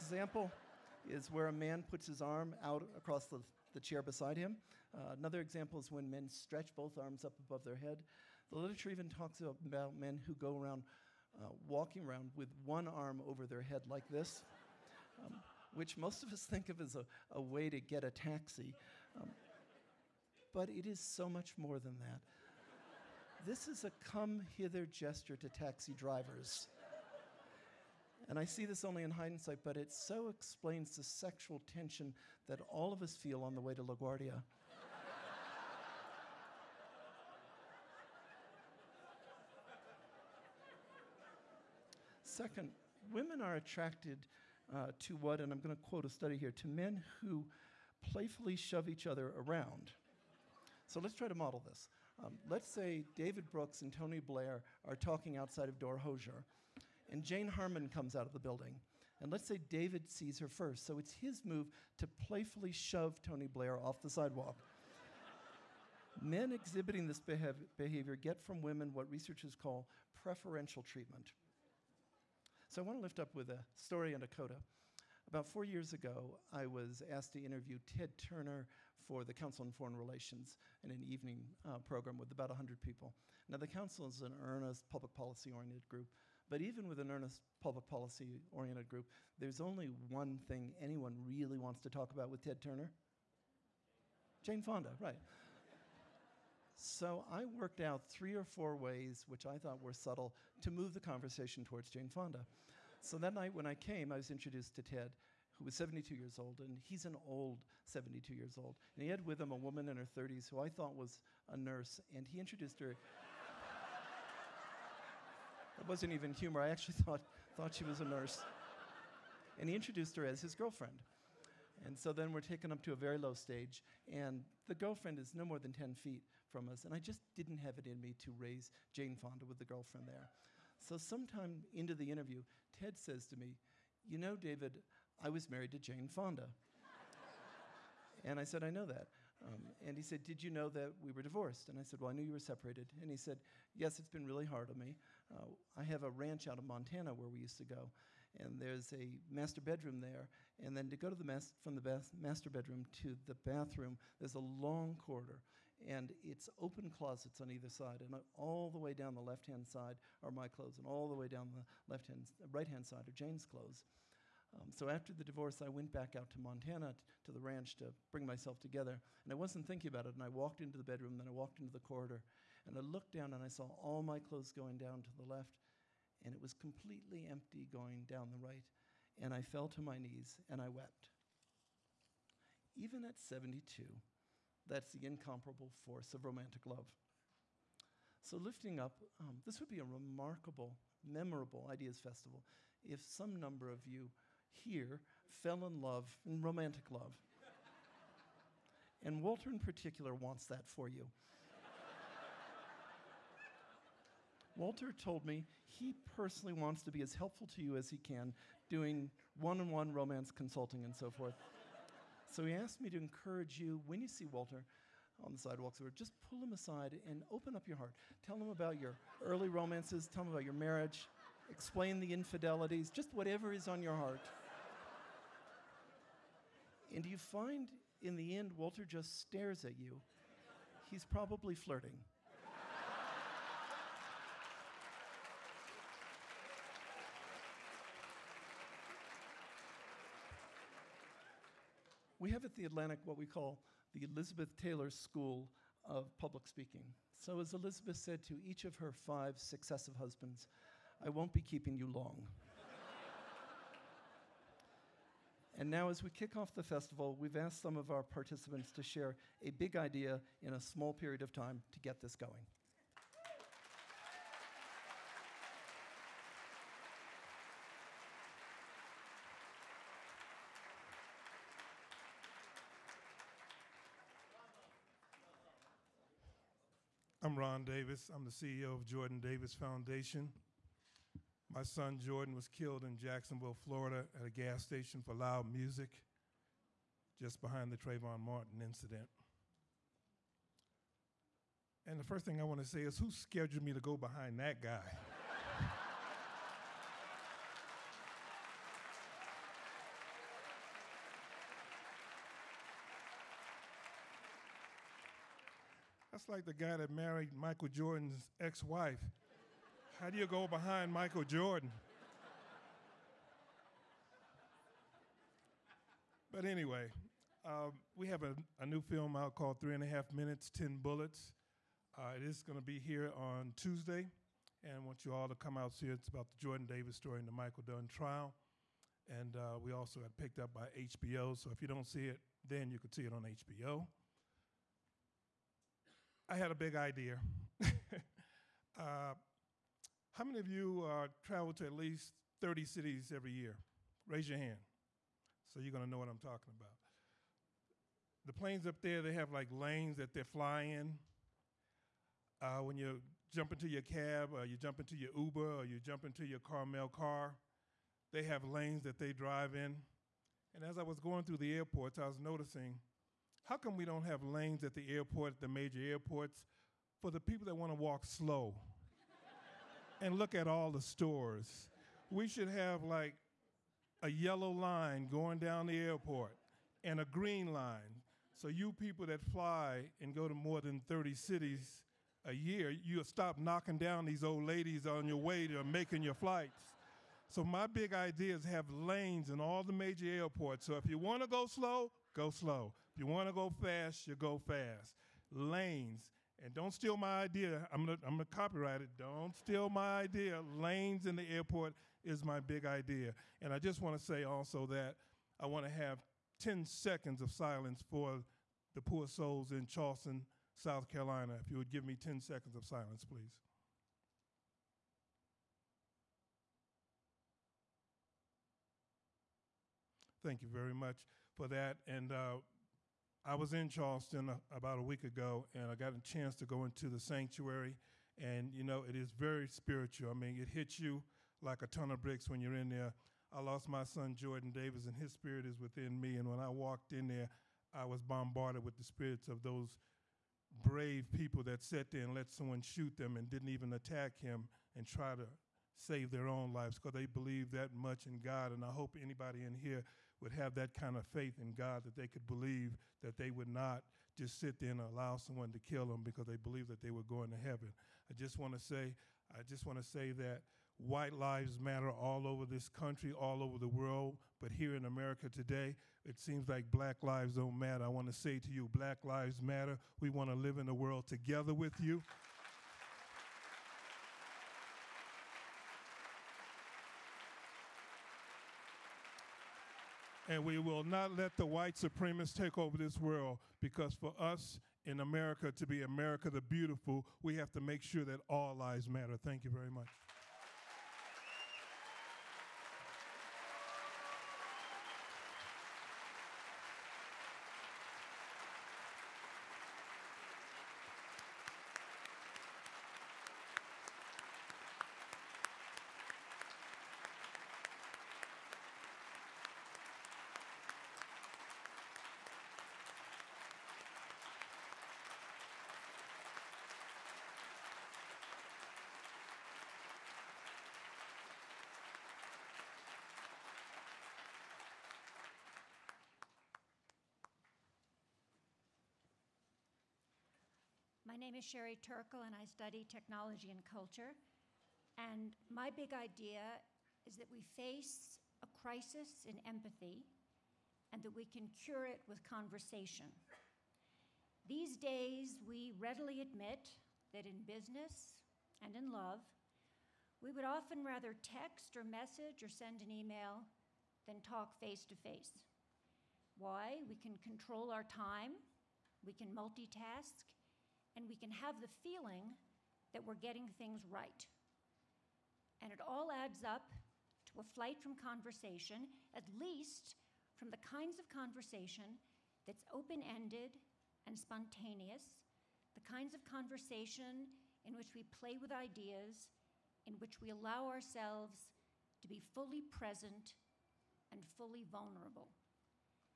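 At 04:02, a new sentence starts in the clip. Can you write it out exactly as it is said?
we have at the Atlantic what we call the Elizabeth Taylor School of Public Speaking.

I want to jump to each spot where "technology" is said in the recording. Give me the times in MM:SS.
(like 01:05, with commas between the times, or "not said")
08:52.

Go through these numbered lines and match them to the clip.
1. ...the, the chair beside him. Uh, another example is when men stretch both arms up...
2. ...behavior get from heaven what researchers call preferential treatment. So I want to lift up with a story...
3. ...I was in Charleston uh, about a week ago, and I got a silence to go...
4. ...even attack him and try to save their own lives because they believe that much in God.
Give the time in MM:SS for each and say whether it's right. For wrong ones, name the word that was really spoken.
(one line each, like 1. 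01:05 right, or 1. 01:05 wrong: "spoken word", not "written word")
1. 00:03 right
2. 01:07 wrong: "women", not "heaven"
3. 07:03 wrong: "chance", not "silence"
4. 07:23 right.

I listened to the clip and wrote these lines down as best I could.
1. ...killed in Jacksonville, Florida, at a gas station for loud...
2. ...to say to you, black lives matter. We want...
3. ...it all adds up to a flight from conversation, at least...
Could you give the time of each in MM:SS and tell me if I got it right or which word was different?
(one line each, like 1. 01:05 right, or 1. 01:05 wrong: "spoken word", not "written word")
1. 04:42 right
2. 07:48 right
3. 09:25 right.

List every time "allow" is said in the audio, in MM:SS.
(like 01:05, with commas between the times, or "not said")
07:34, 09:40.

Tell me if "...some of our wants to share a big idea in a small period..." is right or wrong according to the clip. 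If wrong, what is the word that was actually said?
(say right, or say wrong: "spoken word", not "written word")
wrong: "participants", not "wants".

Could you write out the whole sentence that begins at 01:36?
so I worked out three or four ways, which I thought were subtle, to move the conversation towards Jane Fonda.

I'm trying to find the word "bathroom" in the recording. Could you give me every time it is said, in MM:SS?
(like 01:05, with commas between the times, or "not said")
02:33.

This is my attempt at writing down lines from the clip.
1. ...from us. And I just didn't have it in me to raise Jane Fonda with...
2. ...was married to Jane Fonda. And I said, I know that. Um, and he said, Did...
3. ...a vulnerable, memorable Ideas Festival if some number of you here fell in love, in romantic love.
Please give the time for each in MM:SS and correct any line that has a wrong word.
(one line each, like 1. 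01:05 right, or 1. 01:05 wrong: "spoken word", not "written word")
1. 02:06 right
2. 02:15 right
3. 03:09 wrong: "remarkable", not "vulnerable".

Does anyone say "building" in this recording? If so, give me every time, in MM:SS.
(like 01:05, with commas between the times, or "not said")
00:58.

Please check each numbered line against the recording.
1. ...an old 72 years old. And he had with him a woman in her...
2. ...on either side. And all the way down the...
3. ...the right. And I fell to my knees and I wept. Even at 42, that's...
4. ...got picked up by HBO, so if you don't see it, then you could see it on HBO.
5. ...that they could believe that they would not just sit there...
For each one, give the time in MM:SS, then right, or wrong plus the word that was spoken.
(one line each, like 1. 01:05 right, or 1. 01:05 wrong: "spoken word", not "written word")
1. 01:47 right
2. 02:37 right
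3. 02:58 wrong: "72", not "42"
4. 05:30 right
5. 07:31 right.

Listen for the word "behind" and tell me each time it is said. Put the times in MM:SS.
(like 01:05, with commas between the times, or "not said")
04:47, 04:53, 05:10.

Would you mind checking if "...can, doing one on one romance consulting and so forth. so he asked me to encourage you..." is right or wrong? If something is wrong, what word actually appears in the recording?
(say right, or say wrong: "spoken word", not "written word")
right.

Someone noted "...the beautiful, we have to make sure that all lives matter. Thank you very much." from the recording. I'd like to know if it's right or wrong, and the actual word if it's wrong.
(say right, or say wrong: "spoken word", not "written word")
right.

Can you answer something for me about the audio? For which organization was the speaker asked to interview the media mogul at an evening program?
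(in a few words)
Council on Foreign Relations.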